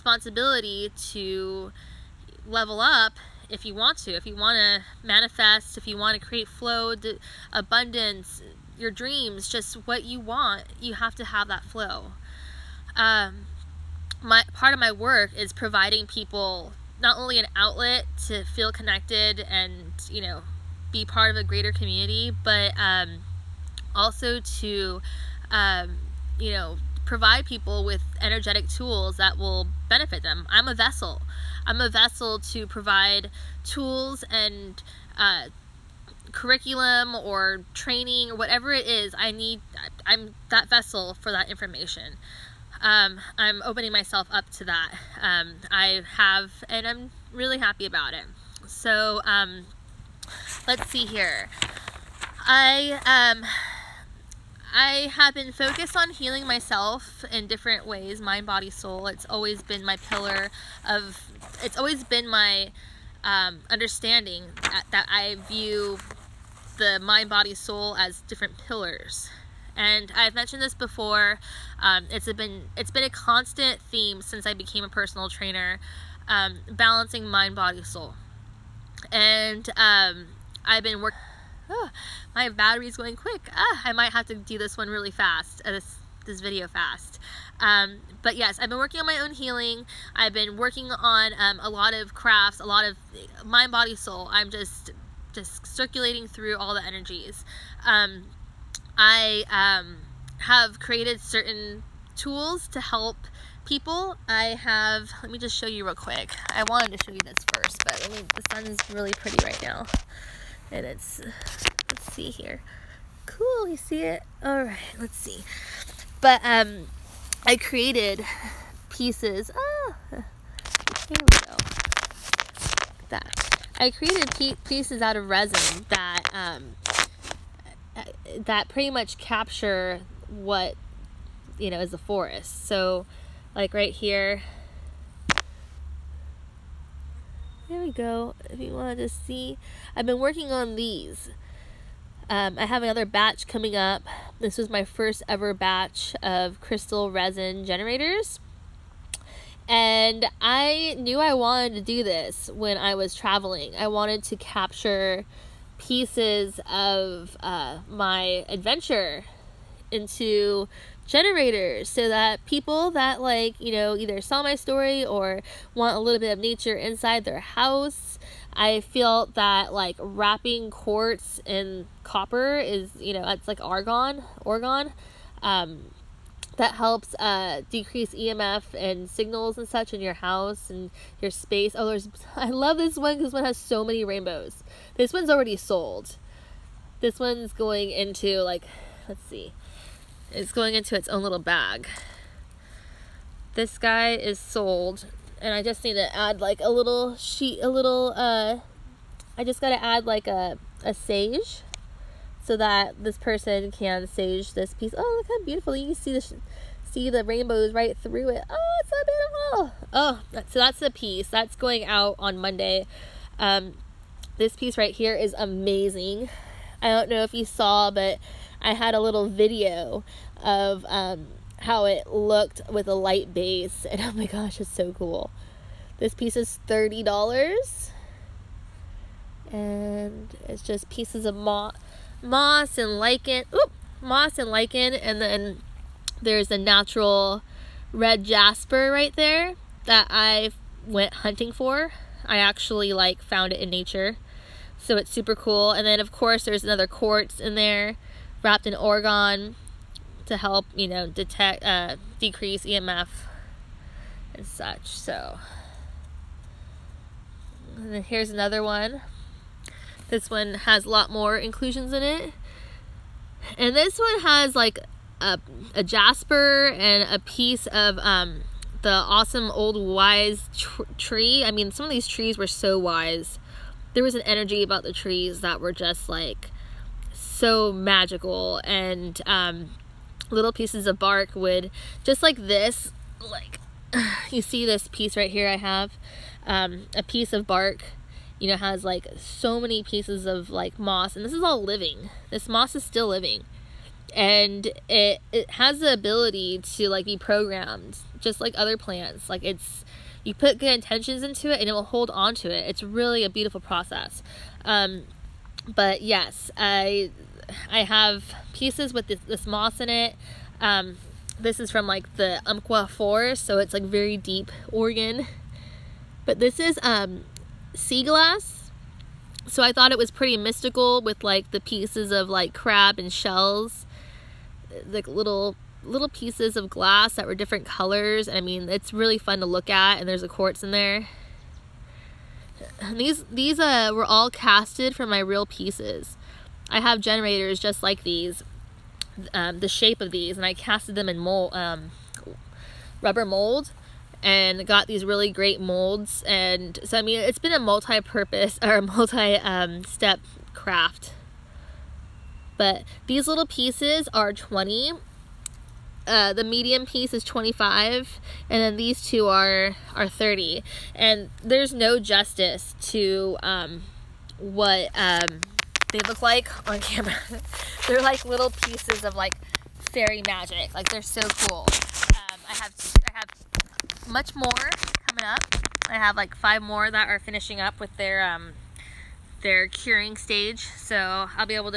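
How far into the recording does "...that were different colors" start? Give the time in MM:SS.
05:27.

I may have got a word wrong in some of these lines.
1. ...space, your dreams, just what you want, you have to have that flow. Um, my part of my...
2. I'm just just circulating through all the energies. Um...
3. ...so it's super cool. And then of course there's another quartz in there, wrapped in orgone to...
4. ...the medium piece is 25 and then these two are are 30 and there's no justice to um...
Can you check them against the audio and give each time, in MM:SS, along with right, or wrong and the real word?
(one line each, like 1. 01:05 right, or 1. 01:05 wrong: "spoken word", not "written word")
1. 00:07 wrong: "abundance", not "space"
2. 01:34 right
3. 04:04 right
4. 05:56 right.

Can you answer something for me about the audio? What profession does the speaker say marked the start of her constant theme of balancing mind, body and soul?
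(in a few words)
personal trainer.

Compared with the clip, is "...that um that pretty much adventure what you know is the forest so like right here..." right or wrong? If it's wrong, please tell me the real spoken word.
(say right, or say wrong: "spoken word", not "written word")
wrong: "capture", not "adventure".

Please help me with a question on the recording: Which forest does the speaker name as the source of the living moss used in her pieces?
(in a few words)
Umpqua forest.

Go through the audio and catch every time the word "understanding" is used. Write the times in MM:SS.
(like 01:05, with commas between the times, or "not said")
01:03.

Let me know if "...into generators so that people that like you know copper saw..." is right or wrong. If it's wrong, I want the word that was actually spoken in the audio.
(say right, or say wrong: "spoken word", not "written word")
wrong: "either", not "copper".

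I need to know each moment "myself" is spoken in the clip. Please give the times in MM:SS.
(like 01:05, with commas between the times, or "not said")
00:43, 00:56.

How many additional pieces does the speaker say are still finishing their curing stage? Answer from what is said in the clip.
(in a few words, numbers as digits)
5.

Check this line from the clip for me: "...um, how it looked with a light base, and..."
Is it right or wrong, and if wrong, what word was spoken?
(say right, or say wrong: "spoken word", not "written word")
right.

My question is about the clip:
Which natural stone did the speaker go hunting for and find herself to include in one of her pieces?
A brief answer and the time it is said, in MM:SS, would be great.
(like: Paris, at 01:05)
red jasper, at 03:57.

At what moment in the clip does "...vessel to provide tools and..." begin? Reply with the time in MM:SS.
00:31.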